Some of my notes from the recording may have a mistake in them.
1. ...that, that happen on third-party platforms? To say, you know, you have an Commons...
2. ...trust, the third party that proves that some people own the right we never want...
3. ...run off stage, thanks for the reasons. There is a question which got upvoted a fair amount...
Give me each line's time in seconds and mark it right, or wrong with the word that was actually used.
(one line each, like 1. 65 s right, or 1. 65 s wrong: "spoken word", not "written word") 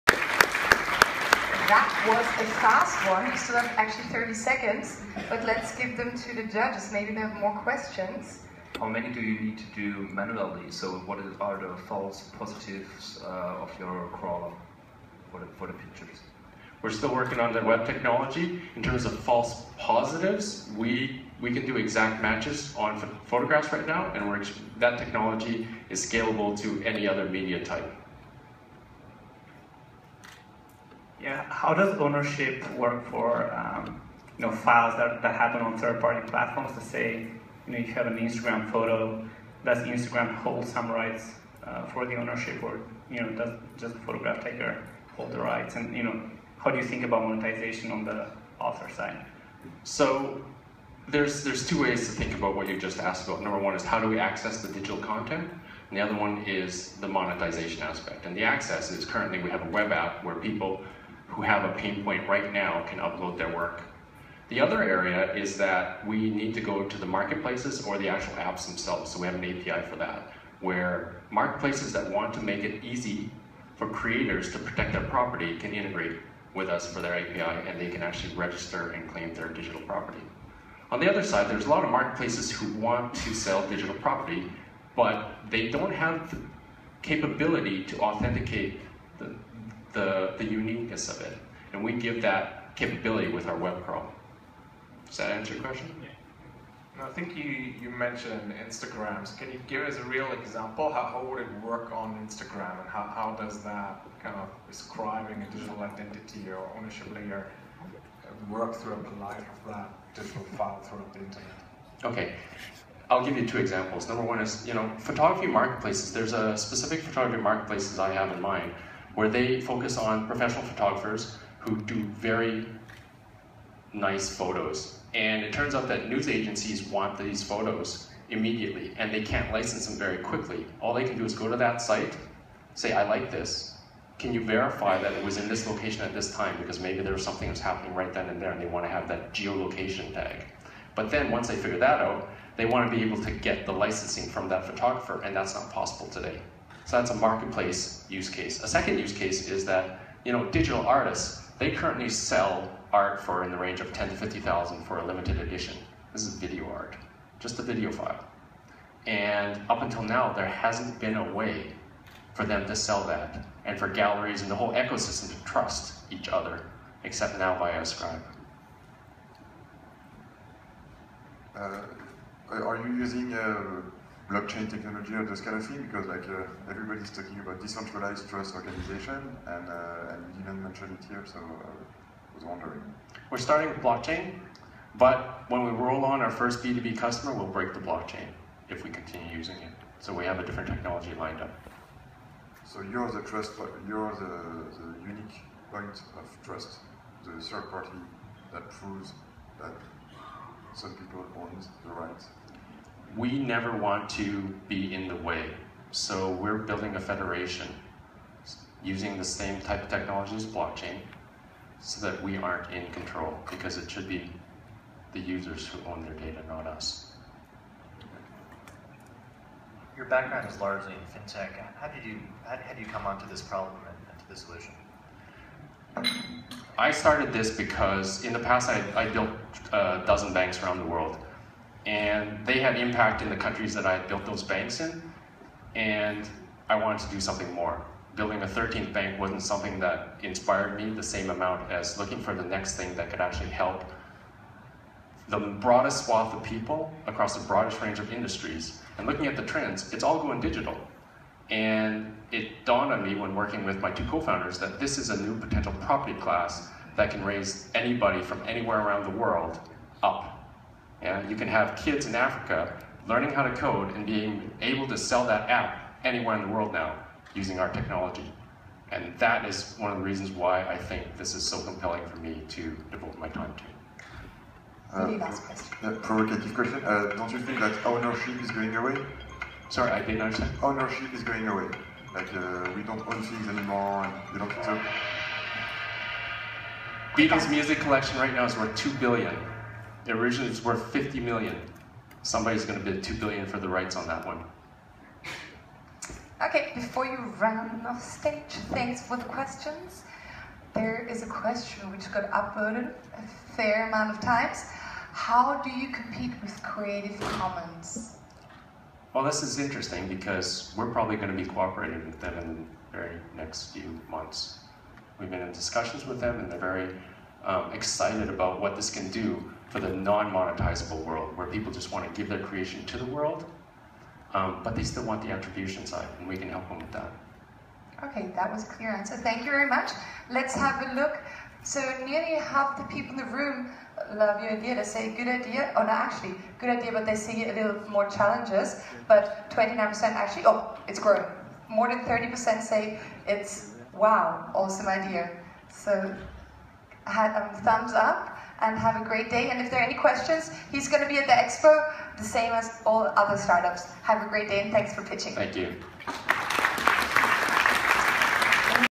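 1. 34 s wrong: "Instagram", not "Commons"
2. 196 s right
3. 297 s wrong: "questions", not "reasons".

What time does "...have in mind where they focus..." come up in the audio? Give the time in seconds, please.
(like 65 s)
118 s.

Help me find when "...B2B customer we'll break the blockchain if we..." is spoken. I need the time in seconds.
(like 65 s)
186 s.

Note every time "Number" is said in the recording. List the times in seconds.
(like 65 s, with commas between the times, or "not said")
53 s, 114 s.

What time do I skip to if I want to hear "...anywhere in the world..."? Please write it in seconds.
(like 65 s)
266 s.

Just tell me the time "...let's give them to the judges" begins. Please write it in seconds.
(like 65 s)
5 s.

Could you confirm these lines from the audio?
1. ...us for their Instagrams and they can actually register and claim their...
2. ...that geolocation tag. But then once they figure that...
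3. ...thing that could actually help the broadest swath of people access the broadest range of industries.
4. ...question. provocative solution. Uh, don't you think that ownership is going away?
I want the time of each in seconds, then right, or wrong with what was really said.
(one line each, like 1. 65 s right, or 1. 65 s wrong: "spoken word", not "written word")
1. 76 s wrong: "API", not "Instagrams"
2. 139 s right
3. 242 s wrong: "across", not "access"
4. 275 s wrong: "question", not "solution".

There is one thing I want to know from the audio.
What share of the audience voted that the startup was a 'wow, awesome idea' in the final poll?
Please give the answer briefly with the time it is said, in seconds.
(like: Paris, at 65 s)
more than 30%, at 341 s.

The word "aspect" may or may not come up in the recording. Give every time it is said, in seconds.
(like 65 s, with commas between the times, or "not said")
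57 s.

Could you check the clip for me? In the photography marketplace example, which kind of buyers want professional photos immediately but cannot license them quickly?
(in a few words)
news agencies.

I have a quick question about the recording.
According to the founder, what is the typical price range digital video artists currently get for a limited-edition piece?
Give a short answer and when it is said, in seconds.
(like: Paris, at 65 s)
10 to 50 thousand, at 153 s.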